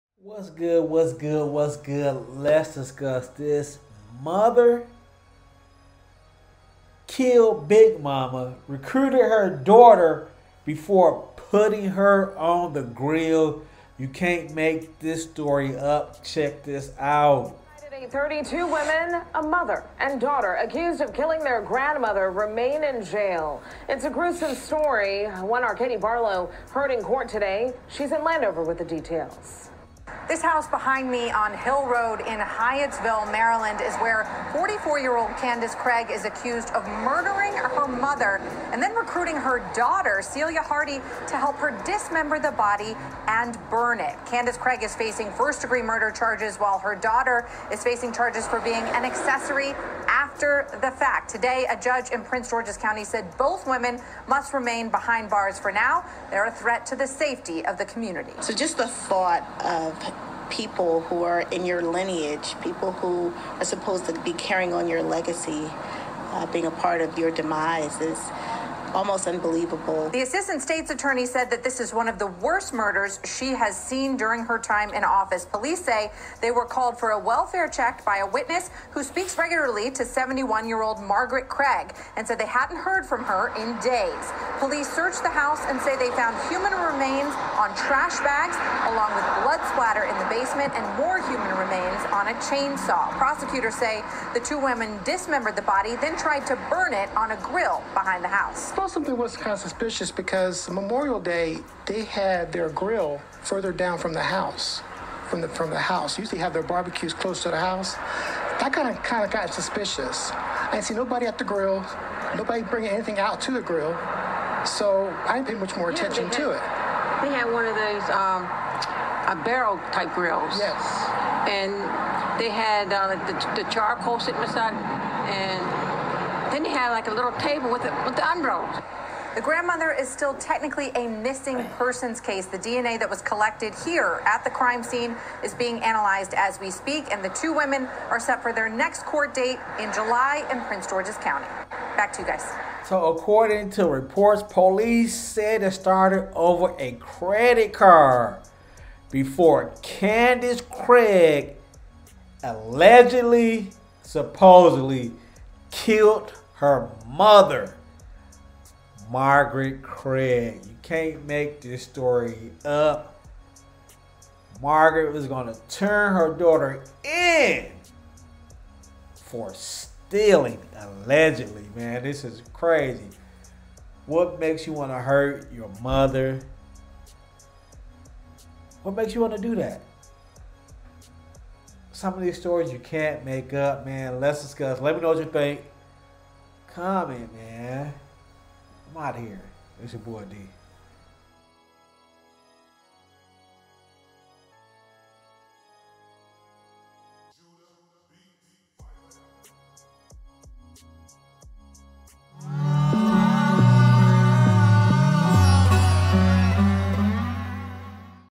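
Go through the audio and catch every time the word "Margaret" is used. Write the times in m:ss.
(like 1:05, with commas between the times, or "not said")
1:21, 2:39, 2:44.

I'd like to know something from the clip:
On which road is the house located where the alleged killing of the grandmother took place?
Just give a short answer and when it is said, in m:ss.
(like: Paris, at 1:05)
Hill Road, at 0:31.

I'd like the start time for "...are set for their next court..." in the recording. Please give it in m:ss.
2:18.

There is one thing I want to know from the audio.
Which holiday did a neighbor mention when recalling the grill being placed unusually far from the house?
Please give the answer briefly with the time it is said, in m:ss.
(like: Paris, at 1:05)
Memorial Day, at 1:40.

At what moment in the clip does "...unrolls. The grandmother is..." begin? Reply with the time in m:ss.
2:08.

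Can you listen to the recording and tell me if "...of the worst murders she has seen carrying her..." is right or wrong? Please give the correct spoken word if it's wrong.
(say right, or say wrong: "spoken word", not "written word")
wrong: "during", not "carrying".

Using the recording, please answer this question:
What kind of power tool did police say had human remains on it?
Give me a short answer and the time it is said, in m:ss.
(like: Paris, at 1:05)
chainsaw, at 1:32.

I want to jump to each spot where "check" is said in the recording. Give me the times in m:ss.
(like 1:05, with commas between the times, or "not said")
0:16, 1:17.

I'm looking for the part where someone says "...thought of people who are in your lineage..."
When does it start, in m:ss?
0:58.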